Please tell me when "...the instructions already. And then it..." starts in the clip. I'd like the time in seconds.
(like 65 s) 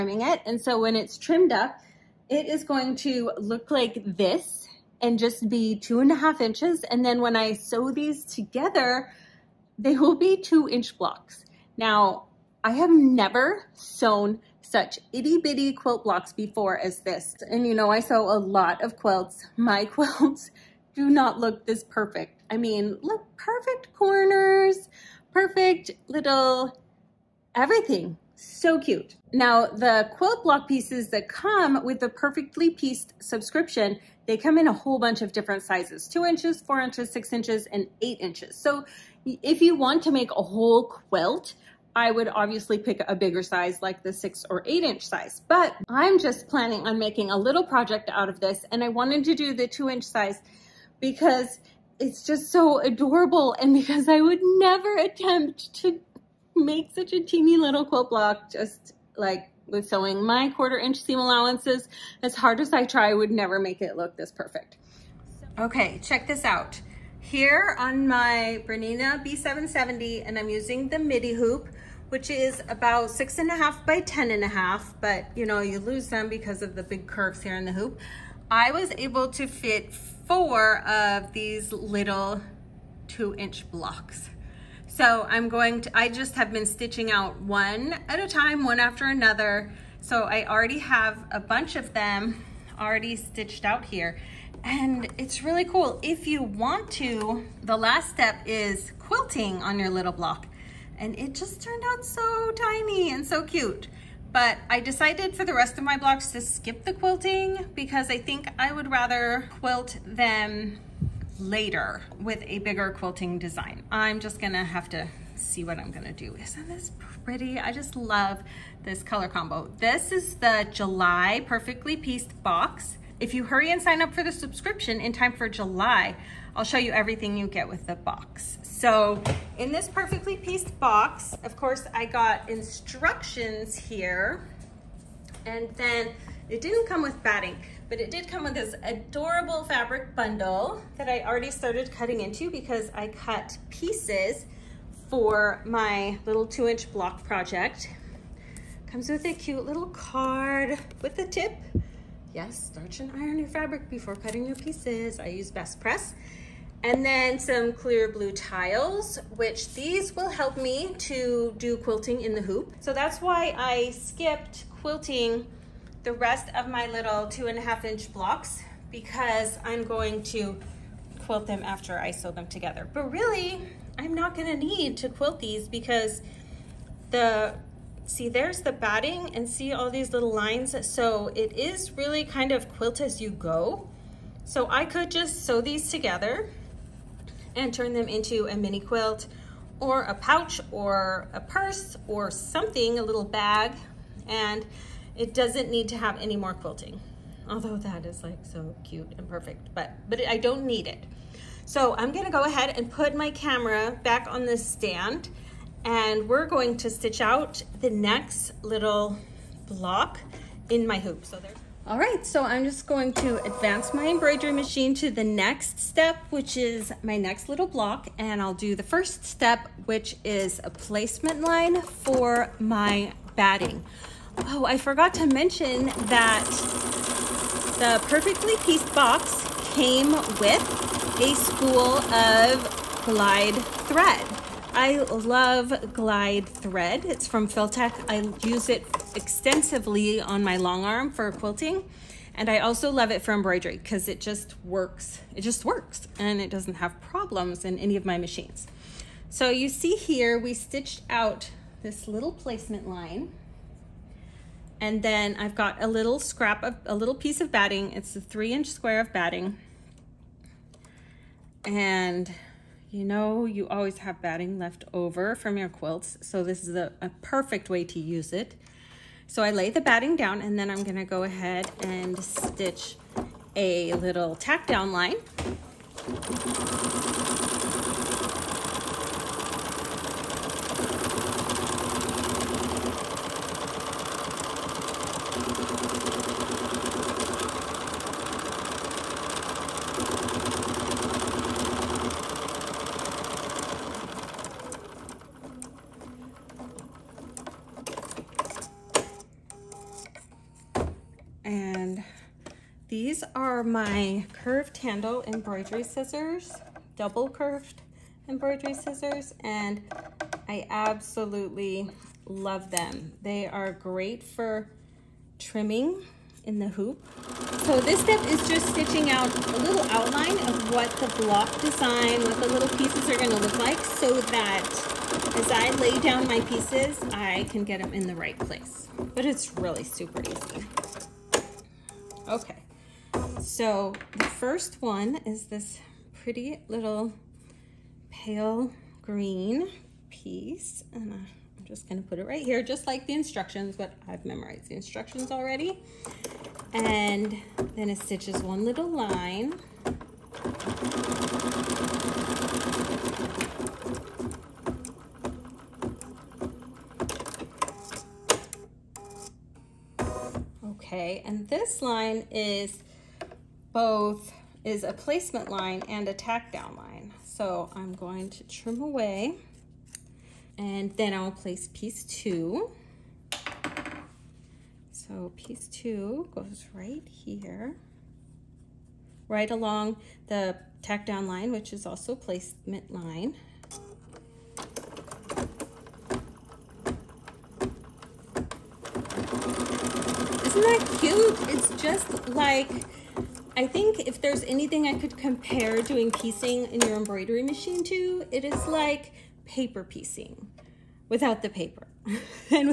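344 s.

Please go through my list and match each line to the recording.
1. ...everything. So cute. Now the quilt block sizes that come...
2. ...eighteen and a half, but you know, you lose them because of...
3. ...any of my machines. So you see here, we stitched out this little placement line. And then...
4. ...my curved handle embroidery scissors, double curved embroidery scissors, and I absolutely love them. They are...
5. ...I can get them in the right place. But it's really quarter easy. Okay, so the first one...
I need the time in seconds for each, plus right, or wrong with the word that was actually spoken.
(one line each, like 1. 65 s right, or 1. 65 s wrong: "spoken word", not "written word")
1. 27 s wrong: "pieces", not "sizes"
2. 74 s wrong: "ten", not "eighteen"
3. 247 s right
4. 303 s right
5. 327 s wrong: "super", not "quarter".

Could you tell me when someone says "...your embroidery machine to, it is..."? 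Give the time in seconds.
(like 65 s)
396 s.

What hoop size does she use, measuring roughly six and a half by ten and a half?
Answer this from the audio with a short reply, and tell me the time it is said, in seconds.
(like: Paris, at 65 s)
midi hoop, at 70 s.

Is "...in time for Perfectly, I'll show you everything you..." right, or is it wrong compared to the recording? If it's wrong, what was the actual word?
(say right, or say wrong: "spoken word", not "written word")
wrong: "July", not "Perfectly".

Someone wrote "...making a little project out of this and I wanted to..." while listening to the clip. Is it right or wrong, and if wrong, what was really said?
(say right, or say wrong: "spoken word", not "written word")
right.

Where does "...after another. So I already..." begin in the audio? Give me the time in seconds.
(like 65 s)
88 s.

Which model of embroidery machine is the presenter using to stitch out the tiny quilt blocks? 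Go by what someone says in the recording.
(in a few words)
Bernina B770.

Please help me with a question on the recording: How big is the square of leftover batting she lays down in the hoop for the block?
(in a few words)
3 inches.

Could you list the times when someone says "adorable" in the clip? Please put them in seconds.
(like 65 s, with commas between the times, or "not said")
52 s, 138 s.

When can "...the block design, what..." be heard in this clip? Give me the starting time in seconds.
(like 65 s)
320 s.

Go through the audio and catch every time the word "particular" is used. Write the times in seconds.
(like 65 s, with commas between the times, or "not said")
not said.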